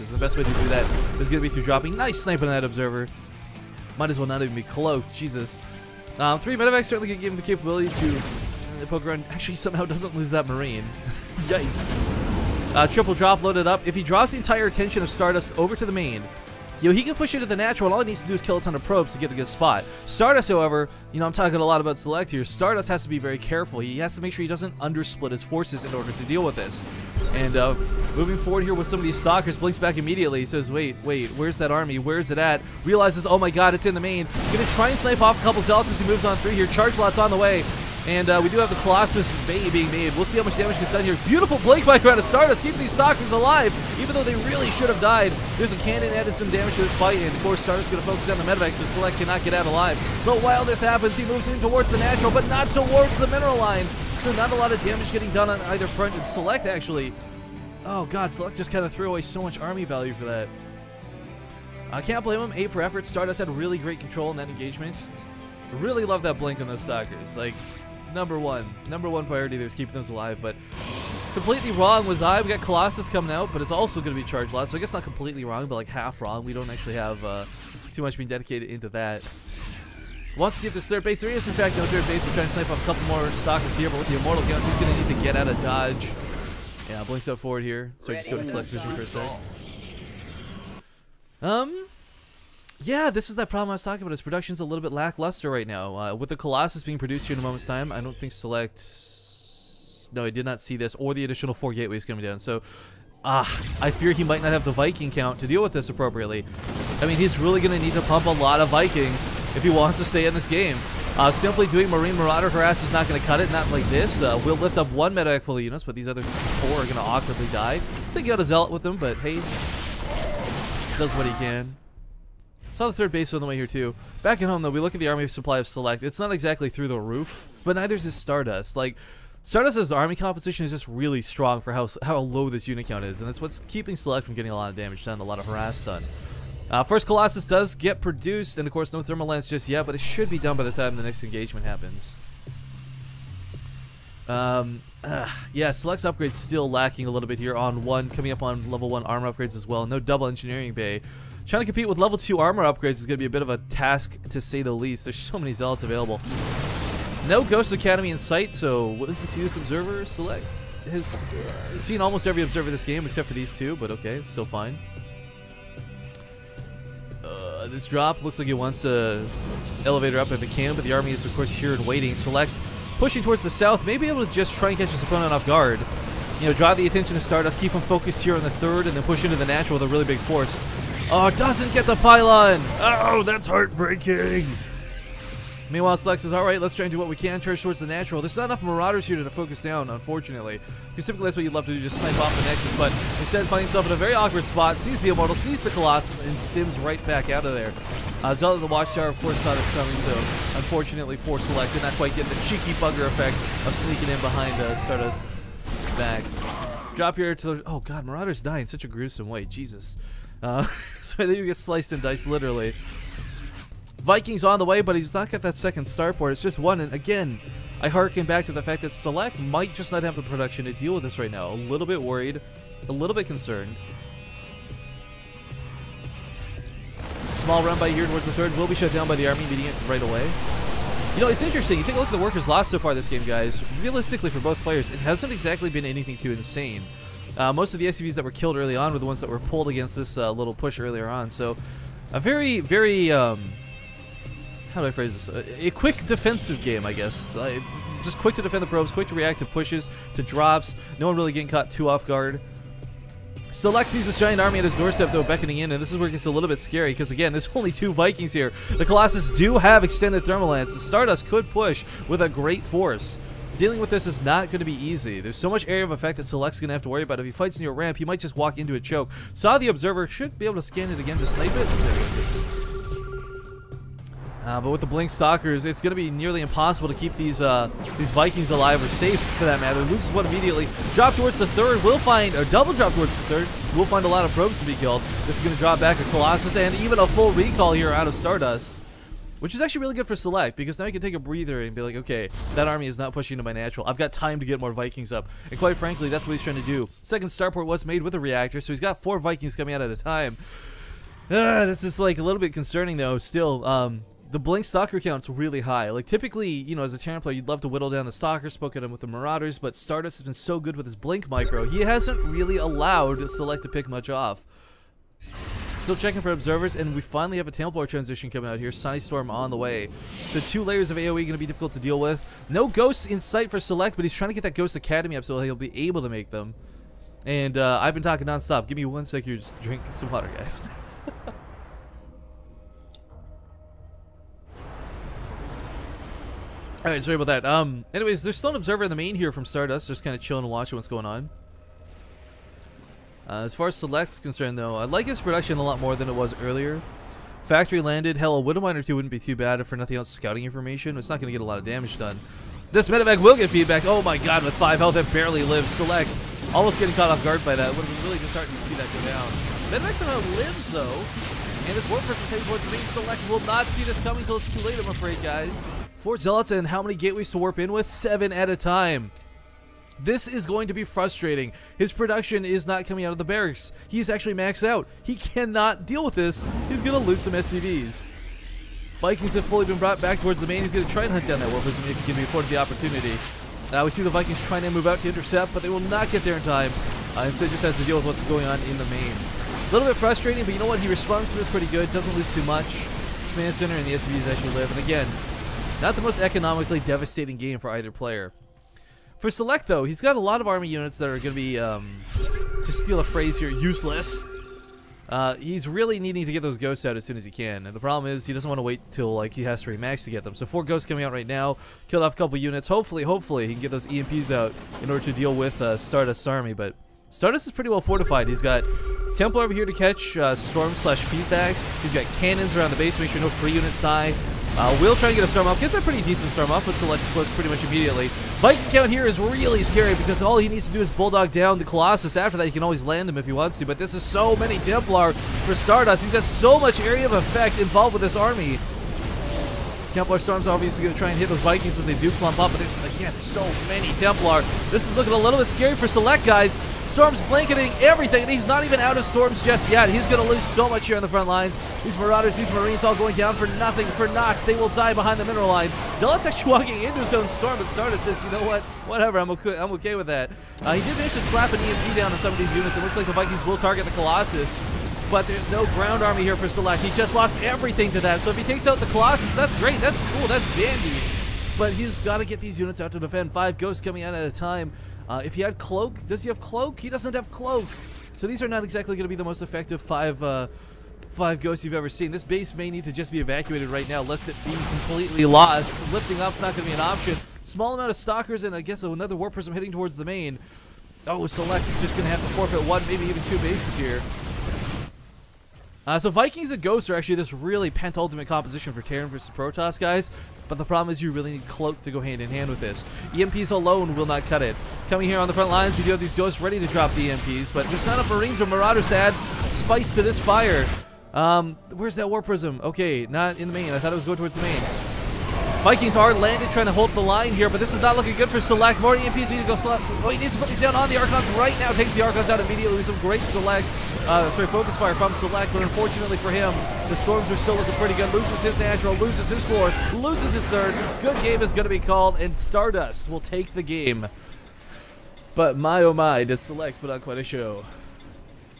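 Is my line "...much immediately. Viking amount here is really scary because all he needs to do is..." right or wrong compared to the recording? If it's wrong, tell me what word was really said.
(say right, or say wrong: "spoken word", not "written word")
wrong: "count", not "amount".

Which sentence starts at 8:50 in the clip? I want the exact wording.
Good game is going to be called, and Stardust will take the game.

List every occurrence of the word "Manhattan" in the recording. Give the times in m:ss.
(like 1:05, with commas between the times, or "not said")
not said.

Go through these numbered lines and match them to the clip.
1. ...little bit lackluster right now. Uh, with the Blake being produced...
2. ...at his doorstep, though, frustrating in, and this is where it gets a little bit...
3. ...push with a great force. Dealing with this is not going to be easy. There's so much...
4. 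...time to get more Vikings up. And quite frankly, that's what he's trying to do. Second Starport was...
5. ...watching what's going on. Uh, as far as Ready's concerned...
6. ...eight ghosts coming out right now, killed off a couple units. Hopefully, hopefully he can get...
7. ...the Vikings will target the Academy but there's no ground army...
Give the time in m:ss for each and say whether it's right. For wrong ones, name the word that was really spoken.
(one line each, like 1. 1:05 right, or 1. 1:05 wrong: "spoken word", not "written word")
1. 1:34 wrong: "Colossus", not "Blake"
2. 4:14 wrong: "beckoning", not "frustrating"
3. 4:21 right
4. 4:54 right
5. 5:40 wrong: "Select", not "Ready"
6. 6:50 wrong: "four", not "eight"
7. 7:43 wrong: "Colossus", not "Academy".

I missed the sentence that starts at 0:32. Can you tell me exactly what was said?
Realizes, oh my god, it's in the main.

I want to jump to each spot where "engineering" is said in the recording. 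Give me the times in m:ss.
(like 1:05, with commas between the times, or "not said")
2:30.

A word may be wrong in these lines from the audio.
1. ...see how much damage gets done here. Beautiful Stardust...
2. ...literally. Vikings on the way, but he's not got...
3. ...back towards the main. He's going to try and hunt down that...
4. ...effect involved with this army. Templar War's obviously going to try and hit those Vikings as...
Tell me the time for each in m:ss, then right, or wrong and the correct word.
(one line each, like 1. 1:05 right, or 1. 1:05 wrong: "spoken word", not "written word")
1. 0:40 wrong: "Blake", not "Stardust"
2. 3:32 right
3. 6:20 right
4. 7:17 wrong: "Storm", not "War".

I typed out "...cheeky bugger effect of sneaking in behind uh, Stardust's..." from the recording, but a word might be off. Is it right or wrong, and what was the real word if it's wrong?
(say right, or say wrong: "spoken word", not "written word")
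right.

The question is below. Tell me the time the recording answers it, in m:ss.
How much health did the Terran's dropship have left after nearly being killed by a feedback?
5:54.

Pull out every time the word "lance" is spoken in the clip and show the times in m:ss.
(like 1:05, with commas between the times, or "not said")
2:19, 4:20.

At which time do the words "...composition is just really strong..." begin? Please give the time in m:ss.
2:10.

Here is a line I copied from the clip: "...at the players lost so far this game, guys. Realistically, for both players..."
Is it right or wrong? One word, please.
wrong.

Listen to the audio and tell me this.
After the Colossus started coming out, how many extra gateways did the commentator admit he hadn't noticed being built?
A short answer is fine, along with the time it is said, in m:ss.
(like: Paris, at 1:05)
4, at 1:41.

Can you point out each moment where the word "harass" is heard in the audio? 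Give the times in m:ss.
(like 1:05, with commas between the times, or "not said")
1:52, 2:15.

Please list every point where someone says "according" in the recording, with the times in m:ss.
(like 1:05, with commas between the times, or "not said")
not said.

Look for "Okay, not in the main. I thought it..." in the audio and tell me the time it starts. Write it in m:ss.
8:32.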